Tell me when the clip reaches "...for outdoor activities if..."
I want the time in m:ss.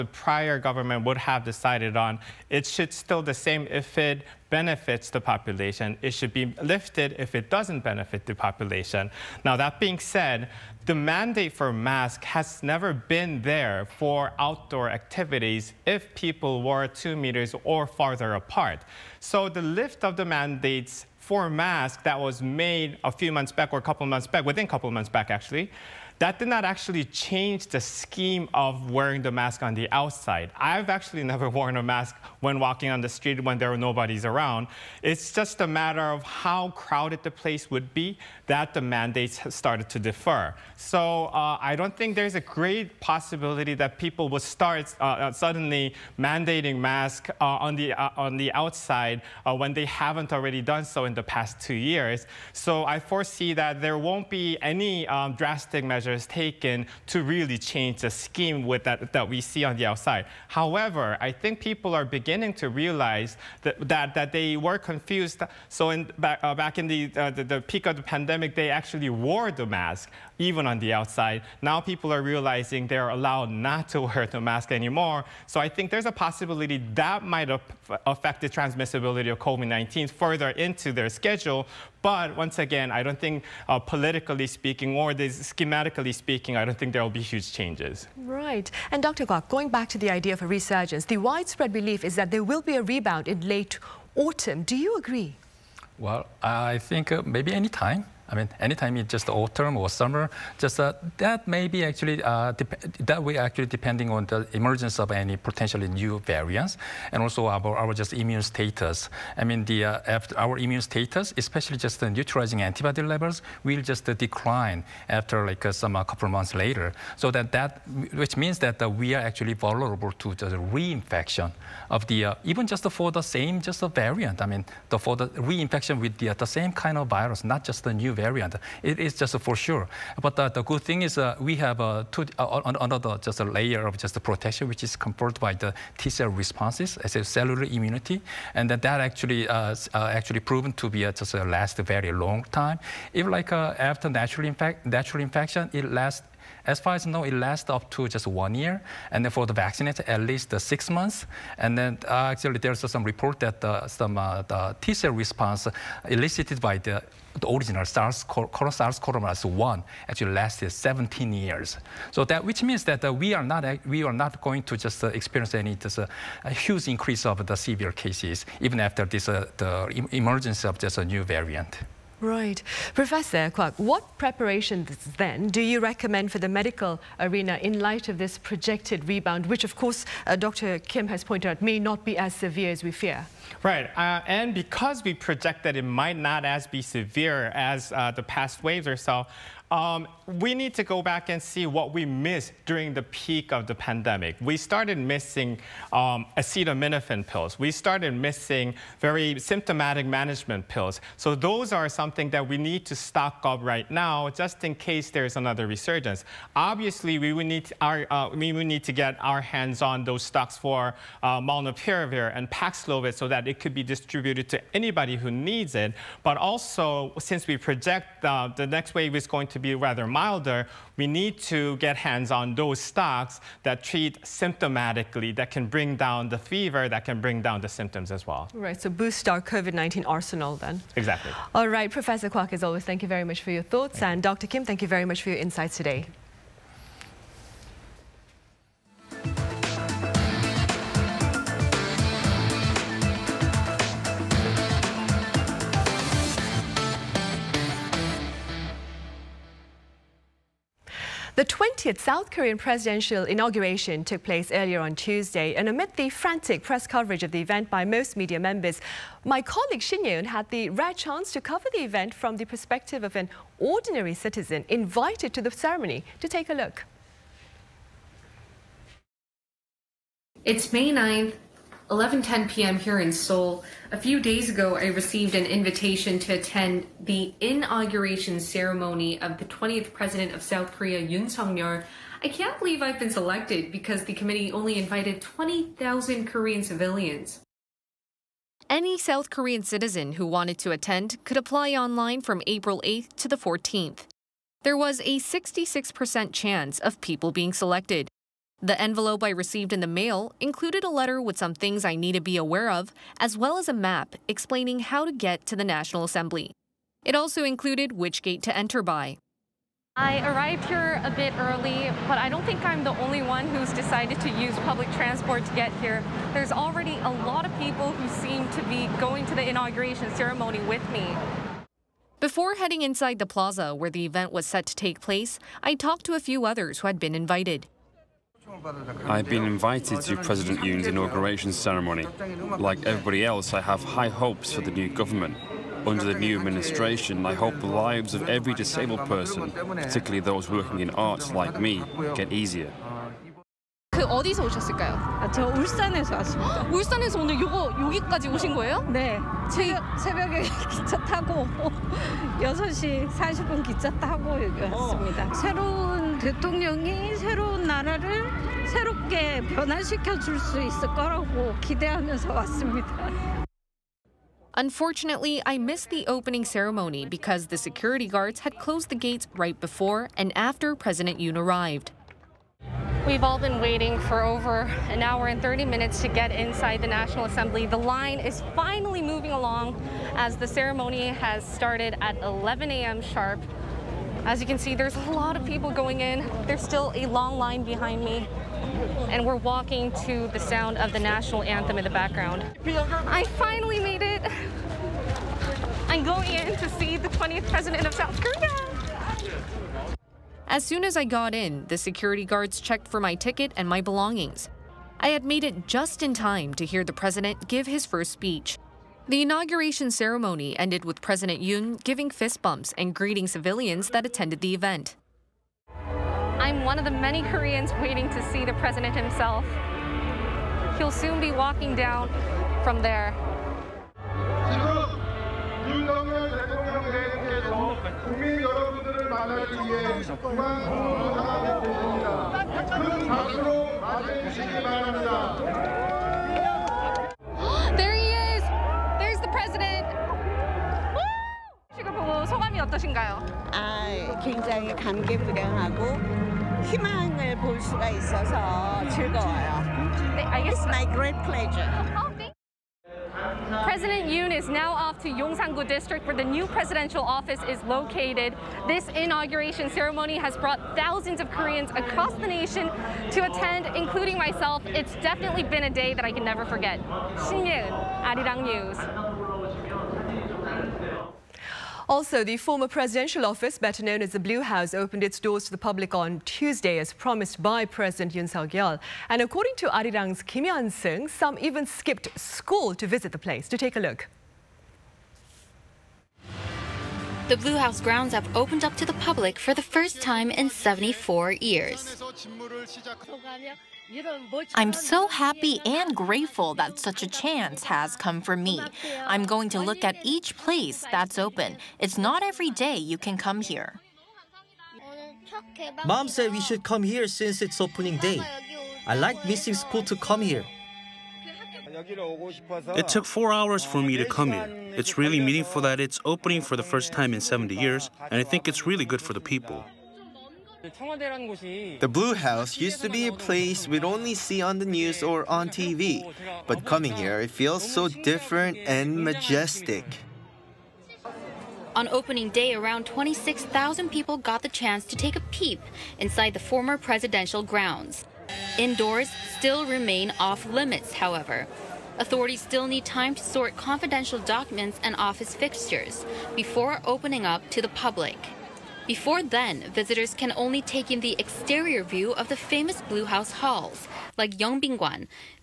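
0:13.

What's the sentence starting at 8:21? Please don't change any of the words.
It's not every day you can come here.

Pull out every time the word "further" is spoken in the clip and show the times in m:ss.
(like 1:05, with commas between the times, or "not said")
1:20.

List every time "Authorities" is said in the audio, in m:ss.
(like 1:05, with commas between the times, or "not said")
9:01.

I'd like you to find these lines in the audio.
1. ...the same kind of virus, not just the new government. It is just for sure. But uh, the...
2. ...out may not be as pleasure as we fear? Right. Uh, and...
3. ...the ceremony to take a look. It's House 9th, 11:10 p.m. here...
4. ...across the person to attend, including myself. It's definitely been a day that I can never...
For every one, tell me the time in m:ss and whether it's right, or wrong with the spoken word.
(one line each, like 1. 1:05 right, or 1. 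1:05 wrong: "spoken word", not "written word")
1. 2:06 wrong: "variant", not "government"
2. 3:01 wrong: "severe", not "pleasure"
3. 4:25 wrong: "May", not "House"
4. 7:41 wrong: "nation", not "person".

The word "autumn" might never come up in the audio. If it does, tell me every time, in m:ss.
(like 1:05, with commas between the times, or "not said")
1:34, 1:39.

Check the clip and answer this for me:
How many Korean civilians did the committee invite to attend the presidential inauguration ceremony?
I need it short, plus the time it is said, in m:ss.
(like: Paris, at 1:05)
20,000, at 4:45.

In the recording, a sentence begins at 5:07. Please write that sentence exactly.
It also included which gate to enter by.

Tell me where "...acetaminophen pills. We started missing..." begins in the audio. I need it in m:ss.
3:16.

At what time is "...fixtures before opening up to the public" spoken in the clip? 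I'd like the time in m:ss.
9:05.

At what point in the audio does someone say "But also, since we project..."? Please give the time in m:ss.
3:36.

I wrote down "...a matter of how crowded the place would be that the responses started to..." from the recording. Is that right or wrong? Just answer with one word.
wrong.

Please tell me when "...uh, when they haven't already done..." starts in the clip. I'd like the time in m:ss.
0:49.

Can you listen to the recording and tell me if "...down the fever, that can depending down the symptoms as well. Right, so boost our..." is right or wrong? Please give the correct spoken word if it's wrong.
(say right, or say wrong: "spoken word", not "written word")
wrong: "bring", not "depending".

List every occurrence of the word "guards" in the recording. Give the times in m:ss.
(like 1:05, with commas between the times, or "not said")
6:08, 6:42.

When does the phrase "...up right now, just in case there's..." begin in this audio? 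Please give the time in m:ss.
3:23.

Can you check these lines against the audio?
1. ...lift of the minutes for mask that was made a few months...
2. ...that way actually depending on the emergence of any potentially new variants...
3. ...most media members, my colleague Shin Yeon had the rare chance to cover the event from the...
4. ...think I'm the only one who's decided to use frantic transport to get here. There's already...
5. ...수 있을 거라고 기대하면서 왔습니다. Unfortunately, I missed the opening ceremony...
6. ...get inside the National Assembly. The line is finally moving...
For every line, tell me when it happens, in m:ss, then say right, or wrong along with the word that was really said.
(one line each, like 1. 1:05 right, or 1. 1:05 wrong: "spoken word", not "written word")
1. 0:19 wrong: "mandates", not "minutes"
2. 1:43 right
3. 4:17 right
4. 5:12 wrong: "public", not "frantic"
5. 6:00 right
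6. 6:16 right.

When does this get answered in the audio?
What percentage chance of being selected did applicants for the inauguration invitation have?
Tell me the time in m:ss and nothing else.
4:55.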